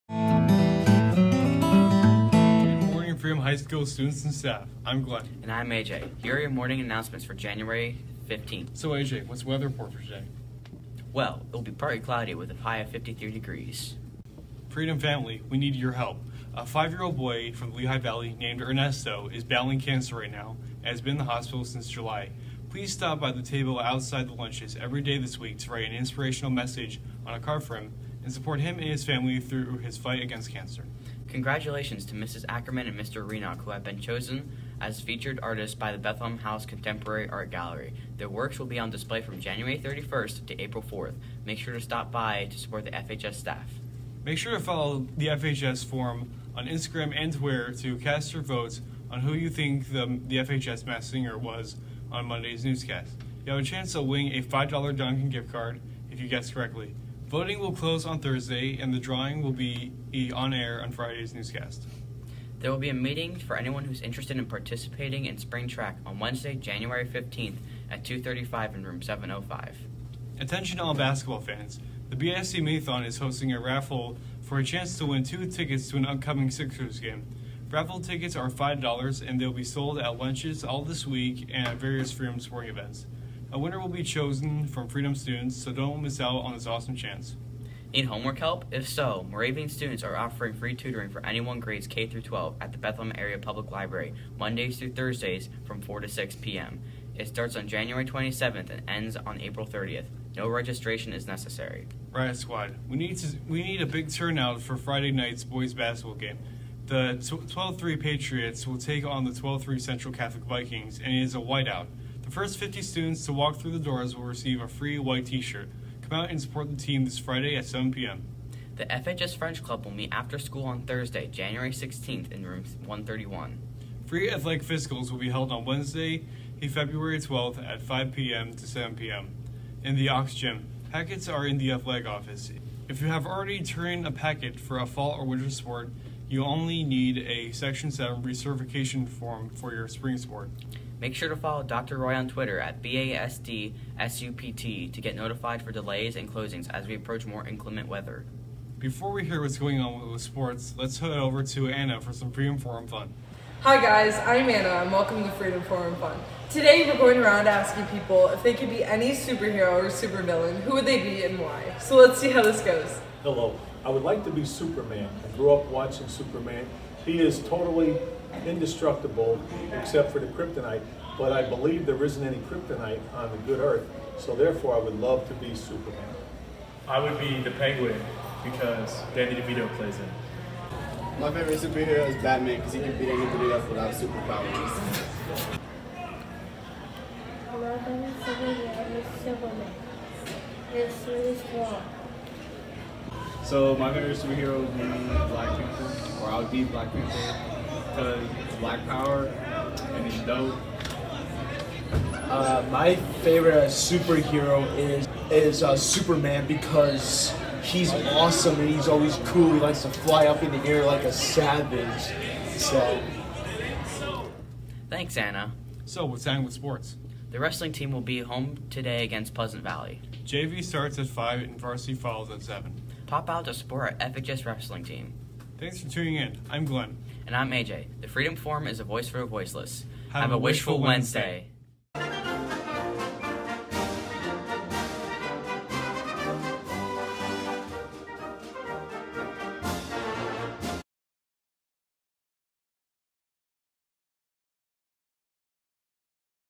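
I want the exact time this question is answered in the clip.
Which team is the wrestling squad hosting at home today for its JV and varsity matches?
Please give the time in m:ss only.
3:39.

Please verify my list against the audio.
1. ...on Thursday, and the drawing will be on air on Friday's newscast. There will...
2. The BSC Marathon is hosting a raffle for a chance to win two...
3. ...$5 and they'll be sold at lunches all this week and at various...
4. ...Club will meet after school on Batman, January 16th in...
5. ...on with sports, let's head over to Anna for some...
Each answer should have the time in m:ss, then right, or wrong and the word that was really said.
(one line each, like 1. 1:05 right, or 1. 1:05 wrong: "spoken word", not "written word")
1. 0:58 right
2. 1:12 right
3. 1:18 right
4. 1:59 wrong: "Thursday", not "Batman"
5. 2:29 right.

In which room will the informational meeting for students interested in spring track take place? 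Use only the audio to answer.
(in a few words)
705.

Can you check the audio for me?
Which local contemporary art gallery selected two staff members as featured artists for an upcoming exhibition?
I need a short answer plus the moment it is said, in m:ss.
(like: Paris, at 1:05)
Bethlehem House, at 0:35.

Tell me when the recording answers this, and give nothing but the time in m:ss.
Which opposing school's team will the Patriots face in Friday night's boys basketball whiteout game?
1:49.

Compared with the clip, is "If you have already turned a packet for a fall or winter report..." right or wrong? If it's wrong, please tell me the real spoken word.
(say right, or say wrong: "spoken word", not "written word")
wrong: "sport", not "report".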